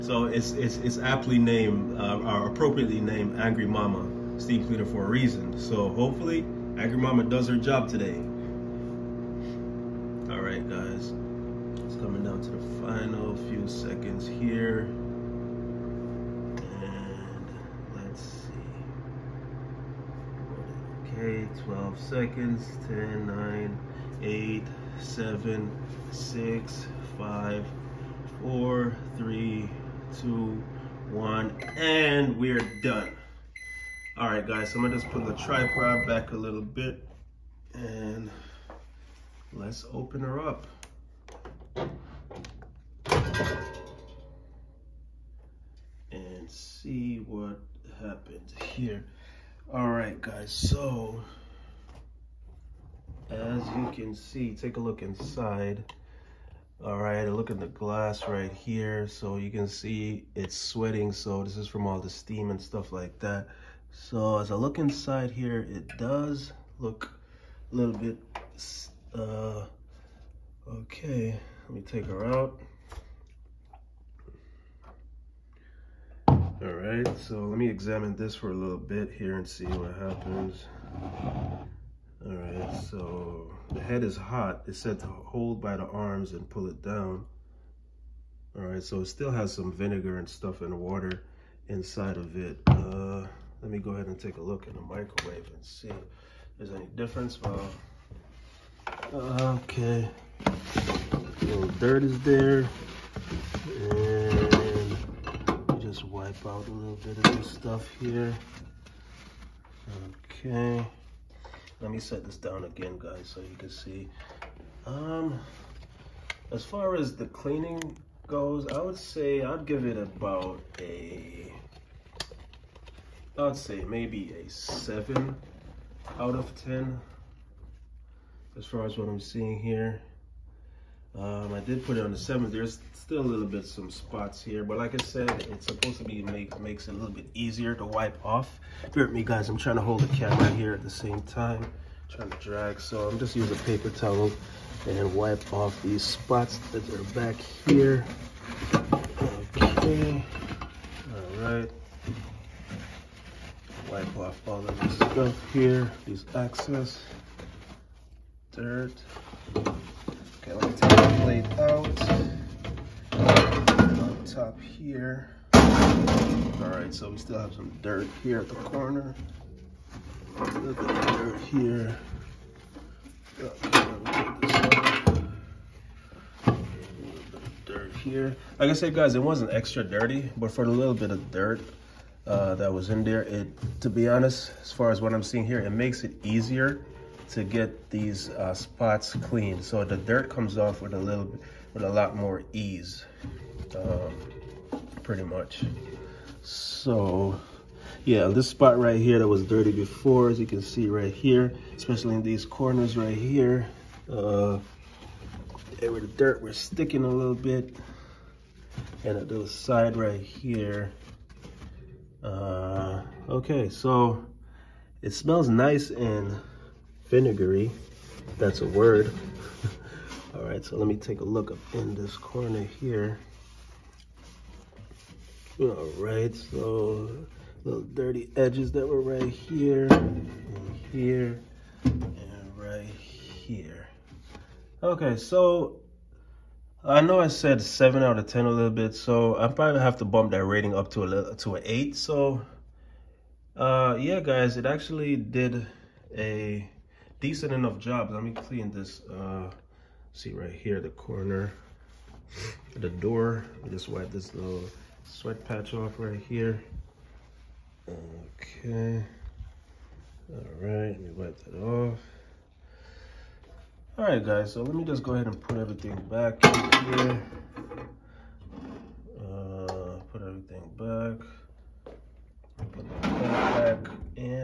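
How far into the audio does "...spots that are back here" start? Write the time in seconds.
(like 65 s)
146 s.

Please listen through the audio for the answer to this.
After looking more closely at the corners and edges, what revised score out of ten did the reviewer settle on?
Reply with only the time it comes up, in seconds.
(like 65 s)
241 s.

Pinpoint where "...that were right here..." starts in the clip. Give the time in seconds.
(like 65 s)
228 s.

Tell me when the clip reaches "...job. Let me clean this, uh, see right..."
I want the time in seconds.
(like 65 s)
247 s.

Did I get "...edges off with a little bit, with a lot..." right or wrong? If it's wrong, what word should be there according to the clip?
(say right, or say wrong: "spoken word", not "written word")
wrong: "comes", not "edges".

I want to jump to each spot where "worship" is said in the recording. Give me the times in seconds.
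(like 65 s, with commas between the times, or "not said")
not said.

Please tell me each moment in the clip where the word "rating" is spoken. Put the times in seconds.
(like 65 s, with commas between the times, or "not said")
240 s.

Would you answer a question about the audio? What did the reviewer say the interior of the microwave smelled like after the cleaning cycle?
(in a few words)
vinegary.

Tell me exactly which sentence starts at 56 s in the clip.
All right, look at the glass right here.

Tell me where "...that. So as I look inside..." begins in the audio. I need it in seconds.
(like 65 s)
63 s.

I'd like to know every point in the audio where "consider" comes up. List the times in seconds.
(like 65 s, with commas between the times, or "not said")
not said.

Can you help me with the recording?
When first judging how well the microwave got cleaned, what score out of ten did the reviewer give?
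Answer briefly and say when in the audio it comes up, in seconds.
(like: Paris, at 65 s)
7, at 124 s.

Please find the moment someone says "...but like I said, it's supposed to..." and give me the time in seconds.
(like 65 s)
134 s.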